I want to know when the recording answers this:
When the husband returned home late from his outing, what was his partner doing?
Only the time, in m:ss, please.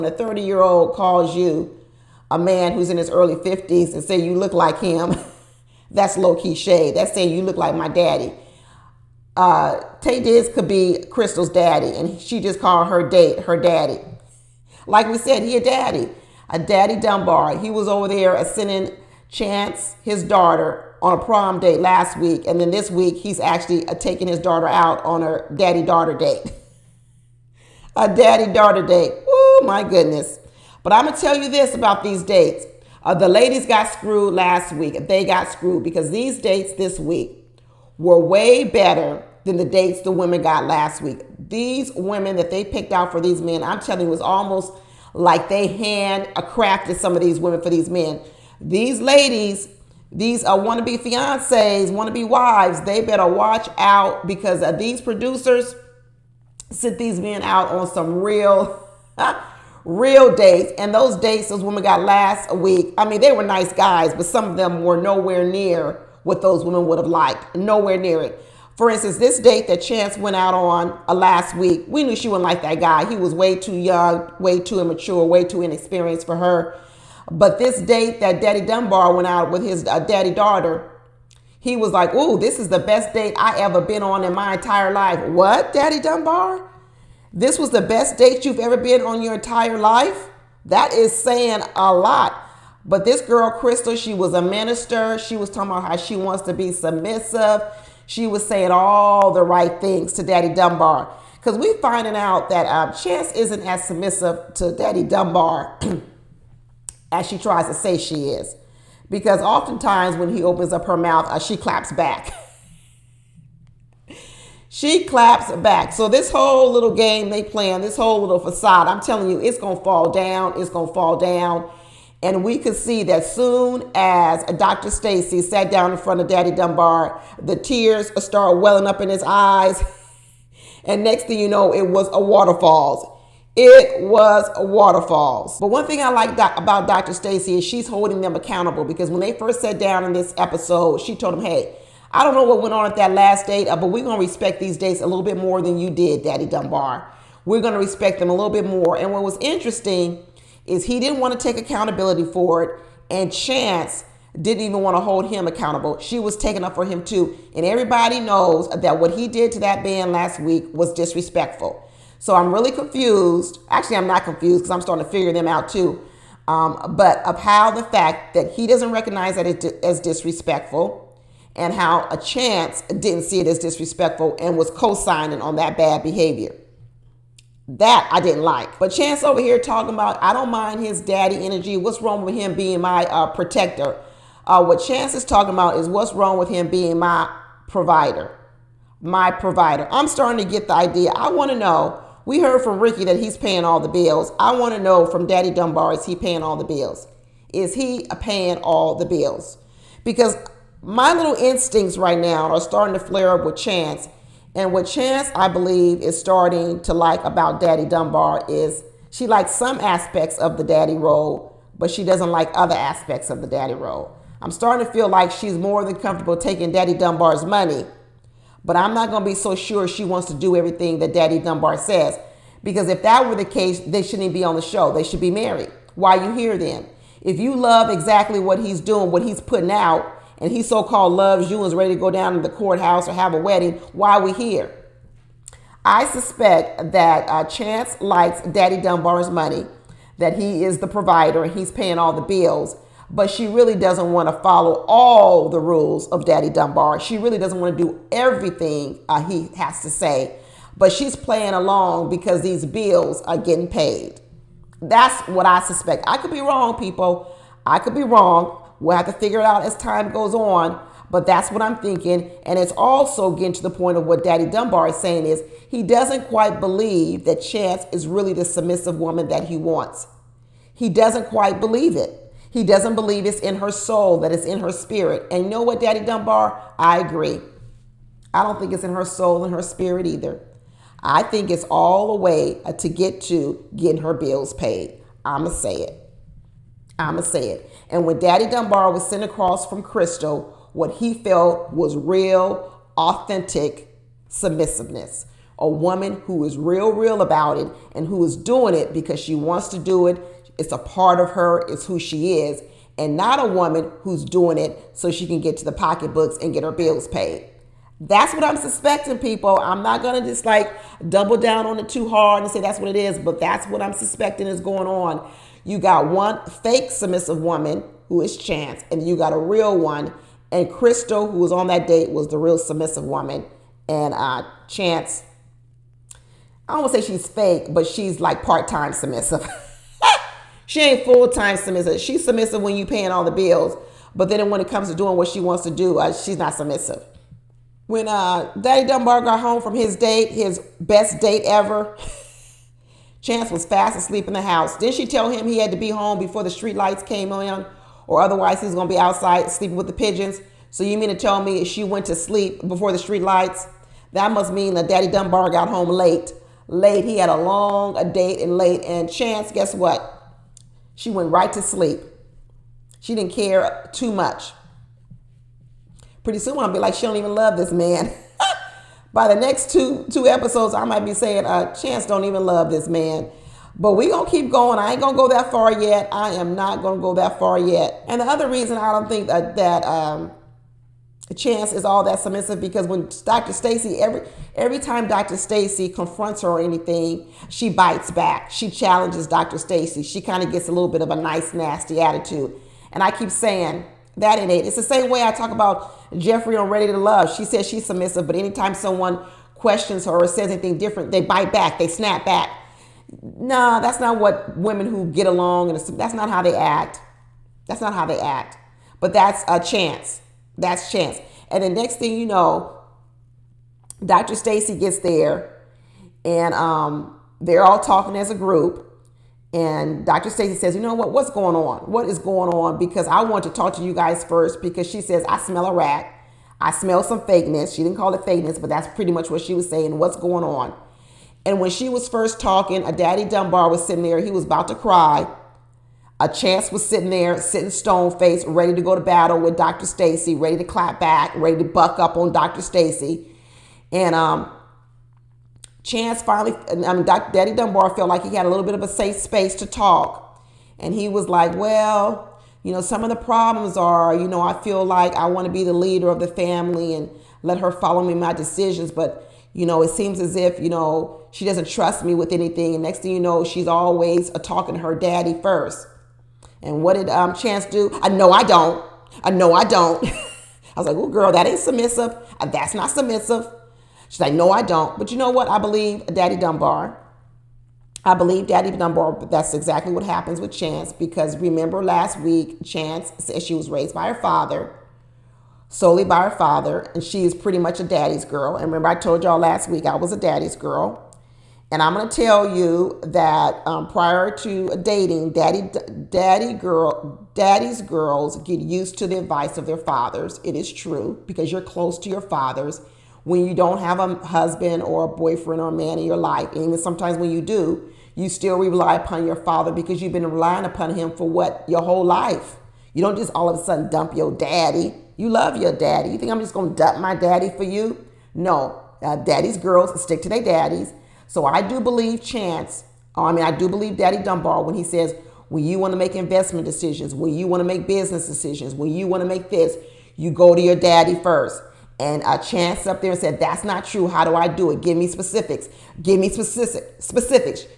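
5:43.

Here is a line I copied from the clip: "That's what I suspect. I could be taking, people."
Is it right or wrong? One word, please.
wrong.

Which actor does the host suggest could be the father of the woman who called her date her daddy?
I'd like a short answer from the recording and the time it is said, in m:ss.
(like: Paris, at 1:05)
Taye Diggs, at 0:10.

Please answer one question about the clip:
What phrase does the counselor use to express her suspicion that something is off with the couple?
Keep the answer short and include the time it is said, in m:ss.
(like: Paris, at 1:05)
I smell a rat, at 7:05.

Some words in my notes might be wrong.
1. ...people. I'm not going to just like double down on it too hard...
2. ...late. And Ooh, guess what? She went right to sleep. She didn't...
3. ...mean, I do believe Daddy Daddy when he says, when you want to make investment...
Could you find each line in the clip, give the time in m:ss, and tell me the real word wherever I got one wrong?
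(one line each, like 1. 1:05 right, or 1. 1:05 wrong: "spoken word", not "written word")
1. 5:09 right
2. 5:58 wrong: "Chance", not "Ooh"
3. 8:43 wrong: "Dunbar", not "Daddy".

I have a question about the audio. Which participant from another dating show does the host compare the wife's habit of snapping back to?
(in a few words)
Jeffrey.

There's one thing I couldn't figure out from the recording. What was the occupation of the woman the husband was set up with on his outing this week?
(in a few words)
Minister.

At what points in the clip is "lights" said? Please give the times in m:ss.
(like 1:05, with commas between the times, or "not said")
5:46, 5:53.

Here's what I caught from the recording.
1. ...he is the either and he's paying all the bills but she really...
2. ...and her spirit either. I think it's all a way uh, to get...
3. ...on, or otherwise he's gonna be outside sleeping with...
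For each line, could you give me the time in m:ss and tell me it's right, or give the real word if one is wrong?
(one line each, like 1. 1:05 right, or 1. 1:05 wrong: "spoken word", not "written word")
1. 4:00 wrong: "provider", not "either"
2. 4:39 right
3. 5:47 right.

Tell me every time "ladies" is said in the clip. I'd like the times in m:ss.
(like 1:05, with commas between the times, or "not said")
0:33, 0:49.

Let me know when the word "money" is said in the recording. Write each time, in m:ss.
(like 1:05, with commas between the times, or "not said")
3:37, 3:59.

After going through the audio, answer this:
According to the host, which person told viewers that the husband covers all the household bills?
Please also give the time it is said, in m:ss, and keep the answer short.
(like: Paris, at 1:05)
Ricky, at 3:12.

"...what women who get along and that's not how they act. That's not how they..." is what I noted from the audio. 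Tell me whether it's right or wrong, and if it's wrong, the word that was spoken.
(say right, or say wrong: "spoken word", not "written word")
right.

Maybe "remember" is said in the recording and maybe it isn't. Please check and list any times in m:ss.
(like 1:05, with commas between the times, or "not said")
8:01, 8:08.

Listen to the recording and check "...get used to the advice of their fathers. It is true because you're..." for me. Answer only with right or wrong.
right.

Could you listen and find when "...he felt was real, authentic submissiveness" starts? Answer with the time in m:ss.
4:50.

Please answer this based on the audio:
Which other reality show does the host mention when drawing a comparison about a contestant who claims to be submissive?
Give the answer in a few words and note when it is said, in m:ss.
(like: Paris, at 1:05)
Ready to Love, at 6:36.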